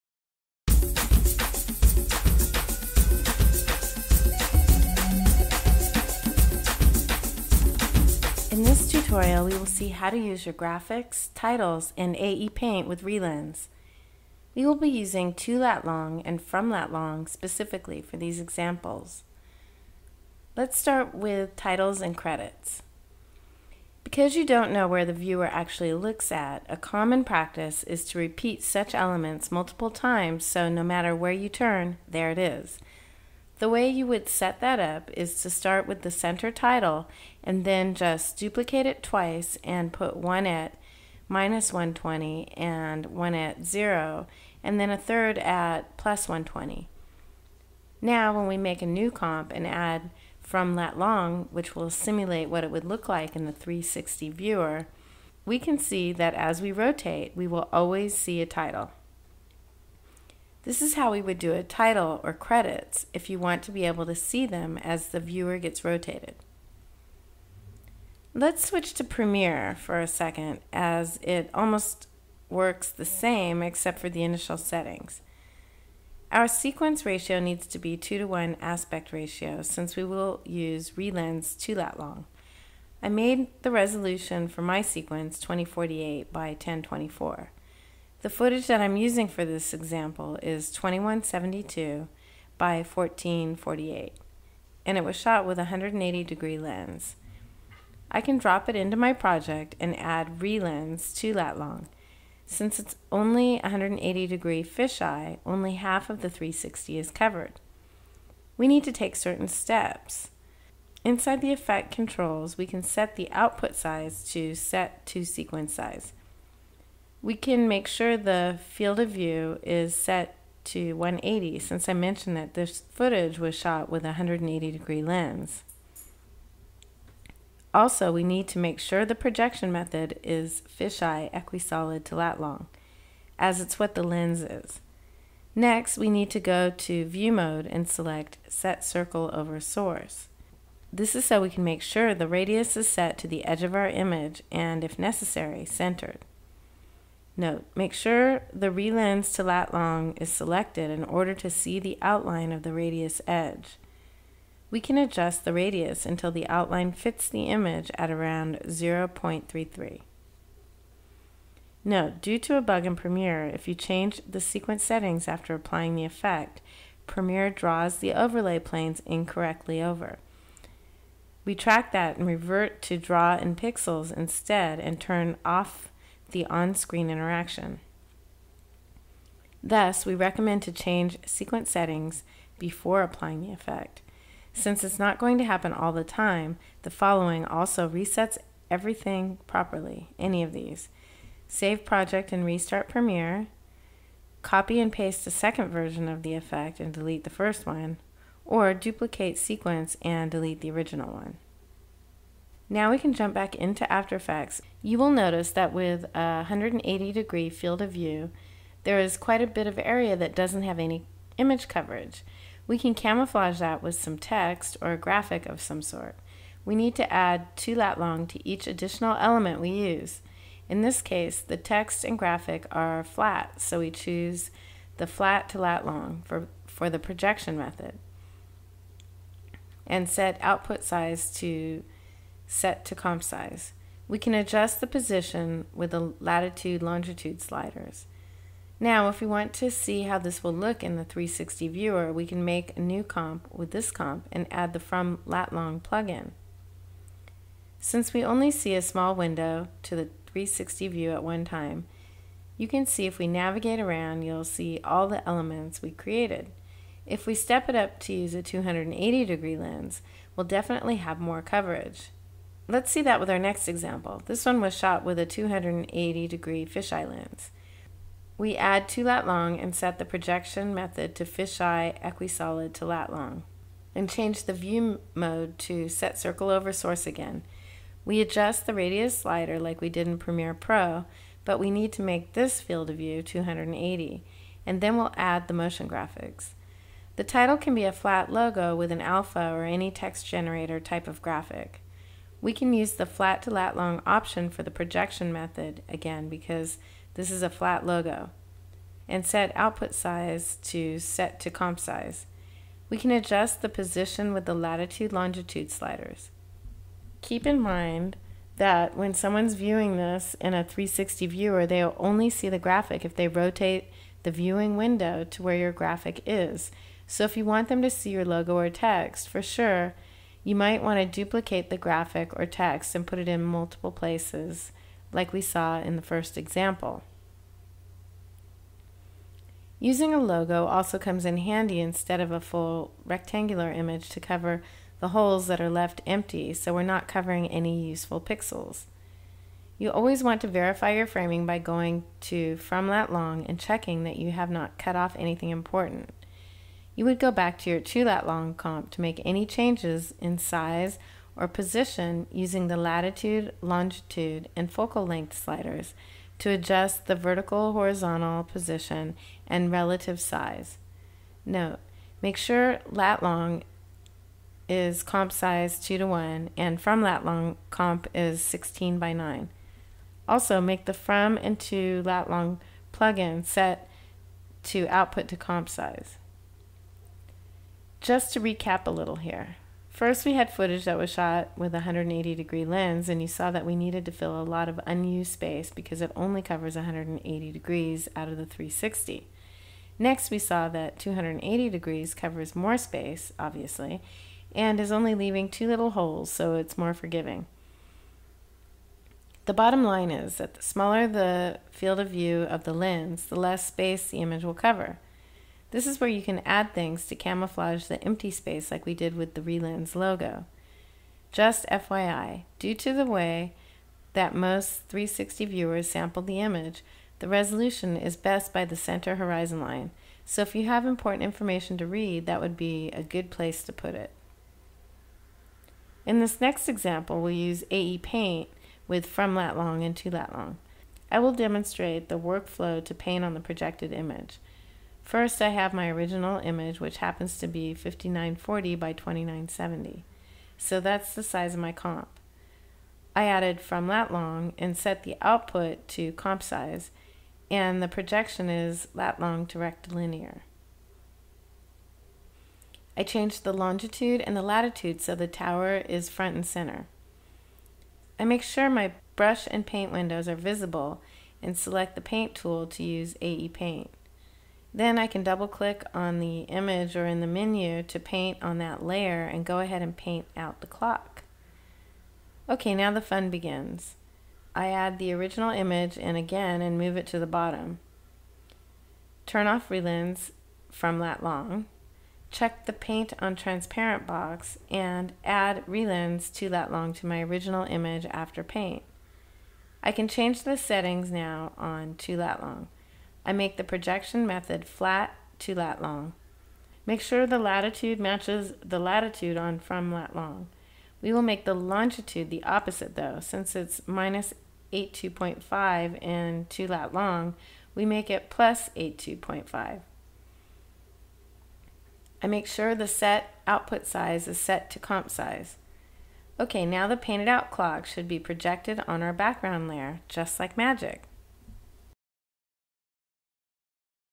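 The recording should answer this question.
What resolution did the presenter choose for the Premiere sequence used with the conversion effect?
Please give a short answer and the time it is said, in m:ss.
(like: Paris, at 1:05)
2048 by 1024, at 1:25.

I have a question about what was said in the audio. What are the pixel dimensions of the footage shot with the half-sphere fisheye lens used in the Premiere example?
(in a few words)
2172 by 1448.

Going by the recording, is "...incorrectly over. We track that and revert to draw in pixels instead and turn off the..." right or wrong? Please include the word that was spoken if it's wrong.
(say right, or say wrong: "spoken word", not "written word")
right.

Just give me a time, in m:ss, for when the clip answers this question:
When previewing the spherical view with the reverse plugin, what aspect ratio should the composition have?
6:08.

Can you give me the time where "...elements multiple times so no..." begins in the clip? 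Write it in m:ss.
0:28.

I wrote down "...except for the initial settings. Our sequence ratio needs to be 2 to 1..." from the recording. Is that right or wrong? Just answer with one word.
right.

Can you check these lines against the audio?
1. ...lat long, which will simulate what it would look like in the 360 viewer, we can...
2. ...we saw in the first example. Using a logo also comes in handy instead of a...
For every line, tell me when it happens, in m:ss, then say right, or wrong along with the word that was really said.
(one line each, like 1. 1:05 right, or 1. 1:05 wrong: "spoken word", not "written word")
1. 0:50 right
2. 5:25 right.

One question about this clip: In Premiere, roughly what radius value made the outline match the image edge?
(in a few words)
0.33.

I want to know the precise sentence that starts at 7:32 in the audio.
I changed the longitude and the latitude so the tower is front and center.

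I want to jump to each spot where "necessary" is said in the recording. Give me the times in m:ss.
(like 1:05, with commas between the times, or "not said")
2:24.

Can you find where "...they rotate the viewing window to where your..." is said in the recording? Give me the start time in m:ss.
5:13.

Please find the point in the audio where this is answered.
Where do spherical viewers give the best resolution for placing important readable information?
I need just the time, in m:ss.
6:58.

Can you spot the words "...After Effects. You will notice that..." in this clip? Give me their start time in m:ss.
3:23.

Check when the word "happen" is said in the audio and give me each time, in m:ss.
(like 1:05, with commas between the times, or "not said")
3:05, 7:16.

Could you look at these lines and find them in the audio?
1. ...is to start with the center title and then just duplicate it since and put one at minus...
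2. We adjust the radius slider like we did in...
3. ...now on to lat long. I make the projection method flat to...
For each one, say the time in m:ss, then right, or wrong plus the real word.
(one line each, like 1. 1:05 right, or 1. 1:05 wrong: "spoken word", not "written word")
1. 0:35 wrong: "twice", not "since"
2. 4:38 right
3. 8:11 right.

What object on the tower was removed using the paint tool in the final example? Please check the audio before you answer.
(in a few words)
the clock.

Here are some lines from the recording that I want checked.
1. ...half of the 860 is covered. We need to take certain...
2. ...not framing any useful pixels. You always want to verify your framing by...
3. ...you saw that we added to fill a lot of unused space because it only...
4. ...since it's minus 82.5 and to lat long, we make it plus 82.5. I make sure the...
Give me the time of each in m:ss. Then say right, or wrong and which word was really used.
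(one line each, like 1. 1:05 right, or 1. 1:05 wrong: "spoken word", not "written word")
1. 1:45 wrong: "360", not "860"
2. 5:36 wrong: "covering", not "framing"
3. 6:23 wrong: "needed", not "added"
4. 8:23 right.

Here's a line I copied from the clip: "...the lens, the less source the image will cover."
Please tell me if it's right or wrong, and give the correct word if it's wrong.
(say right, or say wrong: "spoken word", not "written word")
wrong: "space", not "source".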